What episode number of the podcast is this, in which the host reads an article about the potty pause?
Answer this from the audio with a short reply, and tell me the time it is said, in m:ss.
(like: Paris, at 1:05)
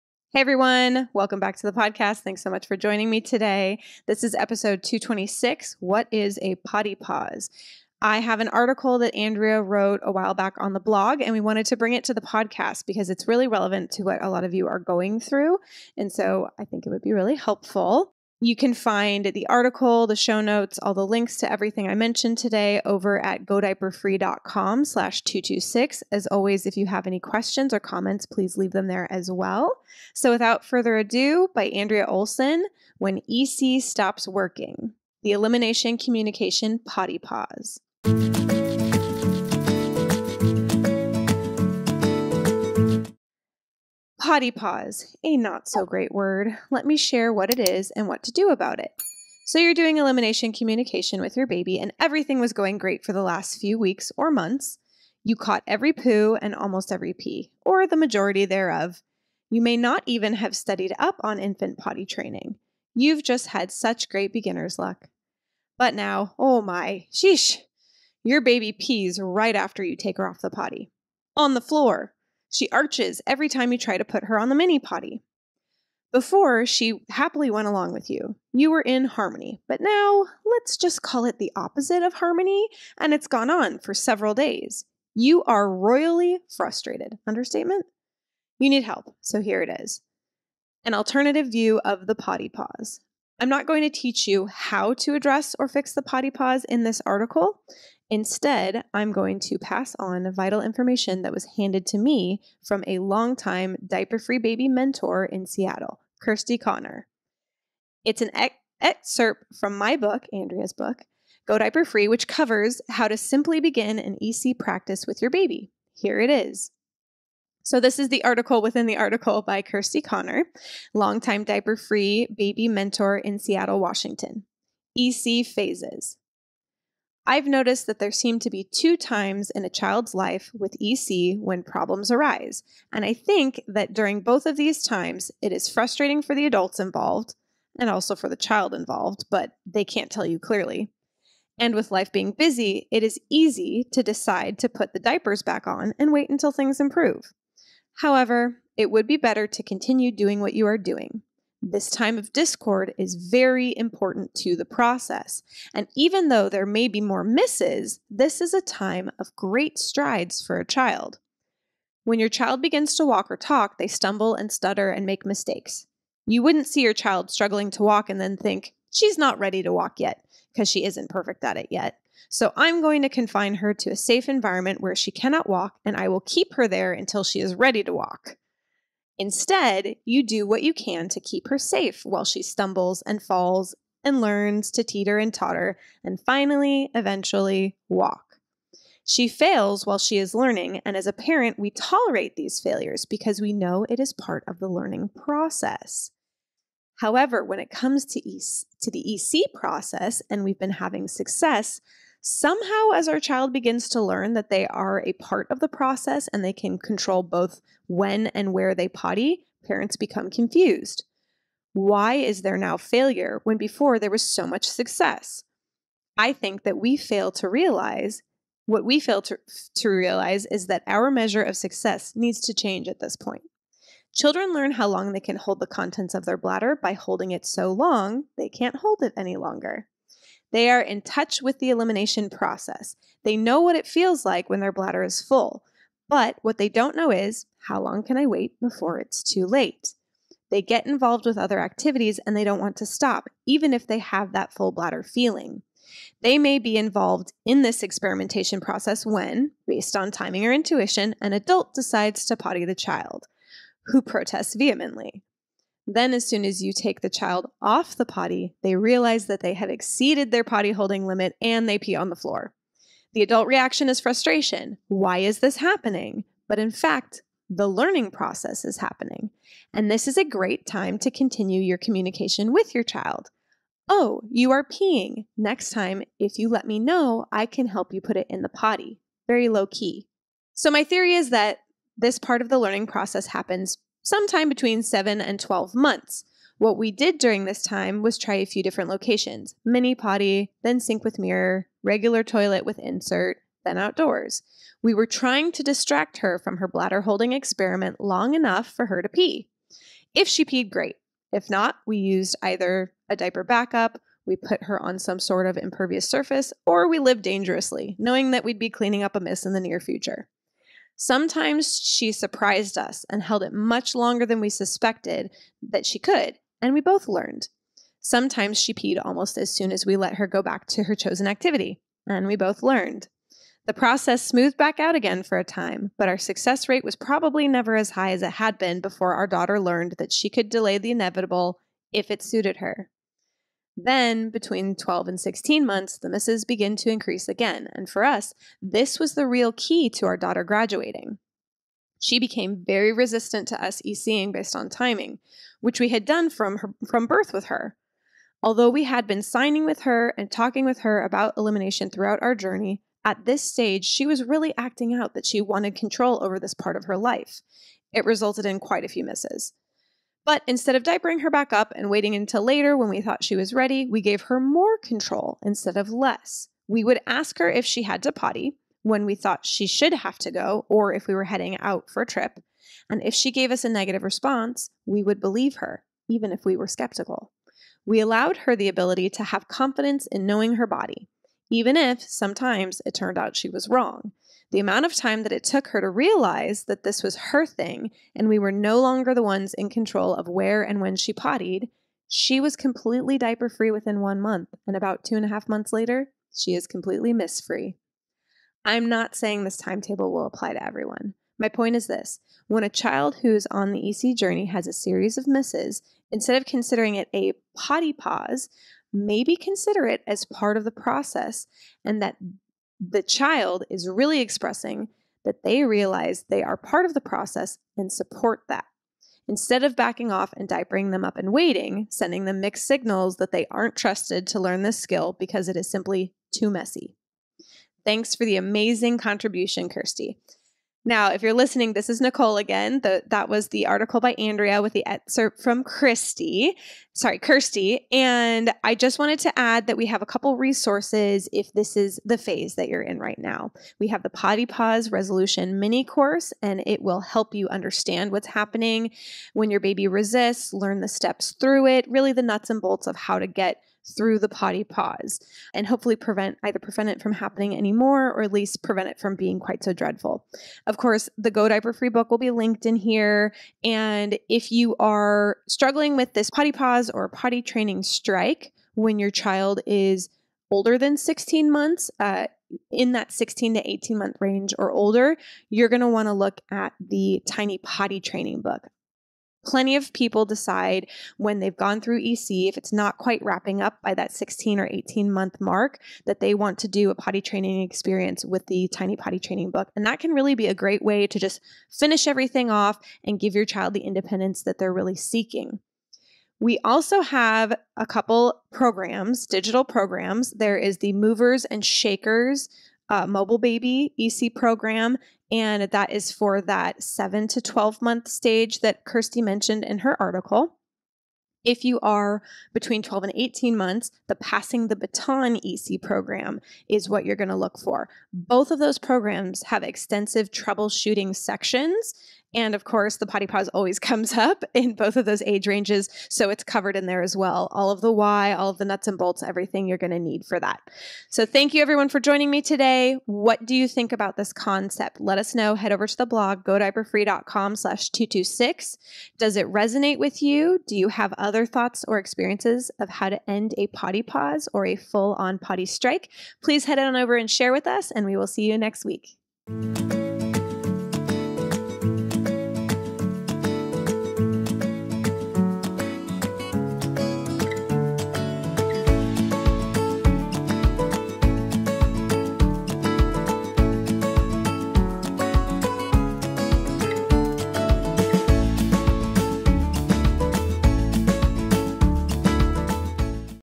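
226, at 0:04.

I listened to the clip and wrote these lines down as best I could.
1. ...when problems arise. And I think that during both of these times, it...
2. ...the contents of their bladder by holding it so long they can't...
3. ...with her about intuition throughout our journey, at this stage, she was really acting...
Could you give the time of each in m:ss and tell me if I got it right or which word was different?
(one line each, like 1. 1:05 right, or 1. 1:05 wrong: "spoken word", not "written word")
1. 2:11 right
2. 3:45 right
3. 5:50 wrong: "elimination", not "intuition".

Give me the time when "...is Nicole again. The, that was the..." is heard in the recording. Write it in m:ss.
7:11.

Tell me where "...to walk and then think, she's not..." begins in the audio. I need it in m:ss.
2:47.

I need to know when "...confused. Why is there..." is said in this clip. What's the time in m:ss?
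3:30.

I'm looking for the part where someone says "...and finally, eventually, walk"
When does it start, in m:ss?
3:06.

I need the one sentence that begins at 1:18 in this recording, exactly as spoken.
You were in harmony, but now let's just call it the opposite of harmony, and it's gone on for several days.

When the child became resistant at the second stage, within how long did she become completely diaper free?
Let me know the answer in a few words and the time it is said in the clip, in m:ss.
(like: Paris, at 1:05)
one month, at 6:34.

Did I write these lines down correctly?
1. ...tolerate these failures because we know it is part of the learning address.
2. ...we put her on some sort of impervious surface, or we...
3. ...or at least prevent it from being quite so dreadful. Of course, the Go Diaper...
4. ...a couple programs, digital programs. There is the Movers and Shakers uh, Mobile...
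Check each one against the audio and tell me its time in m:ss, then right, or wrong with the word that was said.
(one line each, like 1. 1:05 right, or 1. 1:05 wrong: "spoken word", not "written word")
1. 3:11 wrong: "process", not "address"
2. 5:04 right
3. 7:38 right
4. 8:17 right.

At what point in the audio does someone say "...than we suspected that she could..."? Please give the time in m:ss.
5:14.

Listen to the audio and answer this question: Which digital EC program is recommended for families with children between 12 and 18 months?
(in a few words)
Passing the Baton.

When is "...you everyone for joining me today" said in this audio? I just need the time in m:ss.
8:51.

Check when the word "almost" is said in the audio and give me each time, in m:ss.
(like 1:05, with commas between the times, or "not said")
0:56, 5:19.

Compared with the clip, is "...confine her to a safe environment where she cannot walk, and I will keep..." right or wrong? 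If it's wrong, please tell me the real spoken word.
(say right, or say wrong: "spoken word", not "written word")
right.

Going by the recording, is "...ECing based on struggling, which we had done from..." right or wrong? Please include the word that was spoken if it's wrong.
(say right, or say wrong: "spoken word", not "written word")
wrong: "timing", not "struggling".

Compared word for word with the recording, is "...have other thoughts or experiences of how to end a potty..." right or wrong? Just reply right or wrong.
right.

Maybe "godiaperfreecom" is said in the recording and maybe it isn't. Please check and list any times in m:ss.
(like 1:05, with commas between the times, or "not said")
0:23, 8:56.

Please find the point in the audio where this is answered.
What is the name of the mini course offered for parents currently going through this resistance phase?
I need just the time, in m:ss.
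7:24.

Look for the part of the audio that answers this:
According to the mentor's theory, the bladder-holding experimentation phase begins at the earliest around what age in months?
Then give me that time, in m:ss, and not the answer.
4:44.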